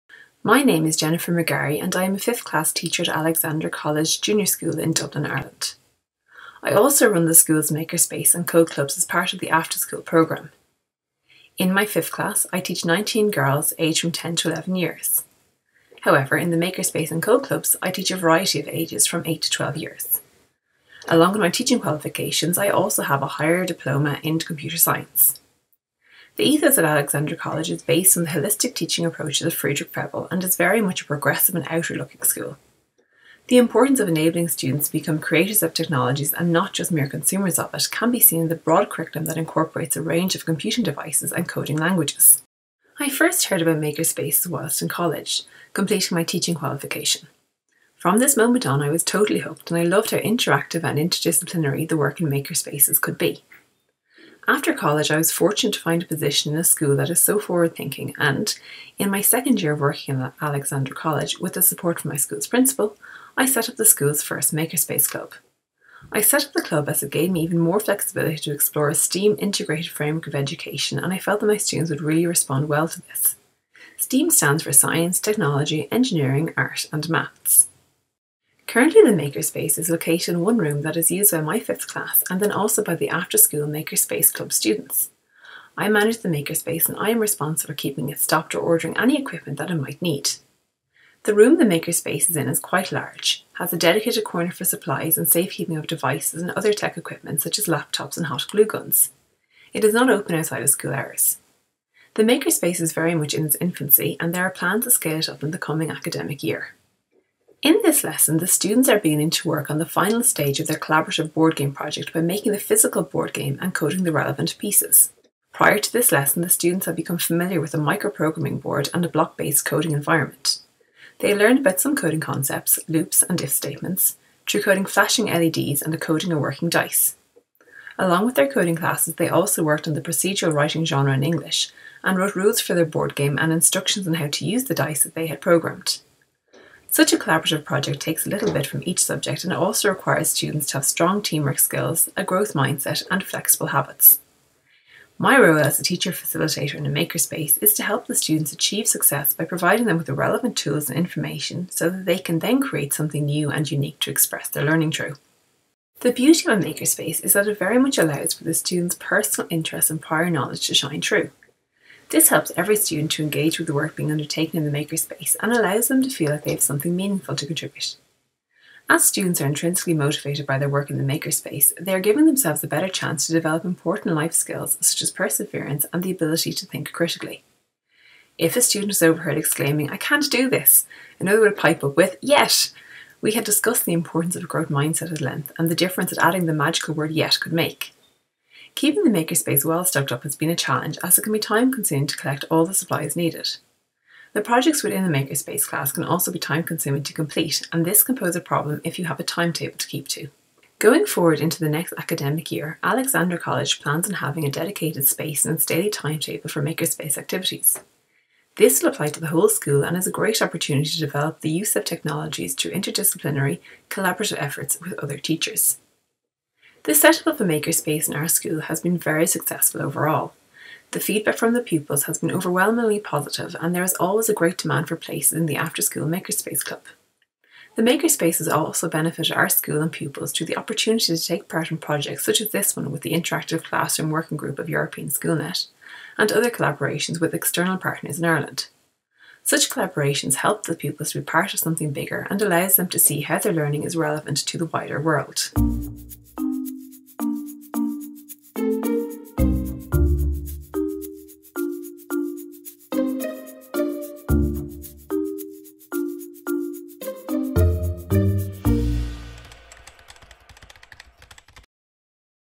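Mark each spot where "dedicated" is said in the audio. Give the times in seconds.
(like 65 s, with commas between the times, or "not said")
93 s, 204 s.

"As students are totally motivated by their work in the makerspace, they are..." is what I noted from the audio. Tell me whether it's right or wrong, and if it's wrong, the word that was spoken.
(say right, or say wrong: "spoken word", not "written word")
wrong: "intrinsically", not "totally".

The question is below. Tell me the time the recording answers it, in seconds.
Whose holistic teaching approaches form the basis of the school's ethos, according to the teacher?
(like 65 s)
29 s.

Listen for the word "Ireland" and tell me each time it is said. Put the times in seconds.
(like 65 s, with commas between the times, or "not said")
5 s, 238 s.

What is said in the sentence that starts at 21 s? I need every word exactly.
Along with my teaching qualifications, I also have a higher diploma in computer science.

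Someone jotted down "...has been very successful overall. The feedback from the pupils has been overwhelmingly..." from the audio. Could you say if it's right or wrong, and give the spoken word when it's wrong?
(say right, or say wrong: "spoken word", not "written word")
right.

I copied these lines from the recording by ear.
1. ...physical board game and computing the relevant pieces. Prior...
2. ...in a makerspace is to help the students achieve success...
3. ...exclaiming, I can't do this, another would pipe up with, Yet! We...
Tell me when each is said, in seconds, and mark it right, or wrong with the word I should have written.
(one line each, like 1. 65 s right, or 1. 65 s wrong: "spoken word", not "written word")
1. 112 s wrong: "coding", not "computing"
2. 146 s right
3. 179 s right.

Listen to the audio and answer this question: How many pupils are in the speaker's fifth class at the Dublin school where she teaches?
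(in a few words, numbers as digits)
19.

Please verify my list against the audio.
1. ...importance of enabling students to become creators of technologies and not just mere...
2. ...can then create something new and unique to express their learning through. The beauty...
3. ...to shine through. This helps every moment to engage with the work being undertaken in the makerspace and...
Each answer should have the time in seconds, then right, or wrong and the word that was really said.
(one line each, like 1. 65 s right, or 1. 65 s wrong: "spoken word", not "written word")
1. 33 s right
2. 152 s right
3. 160 s wrong: "student", not "moment".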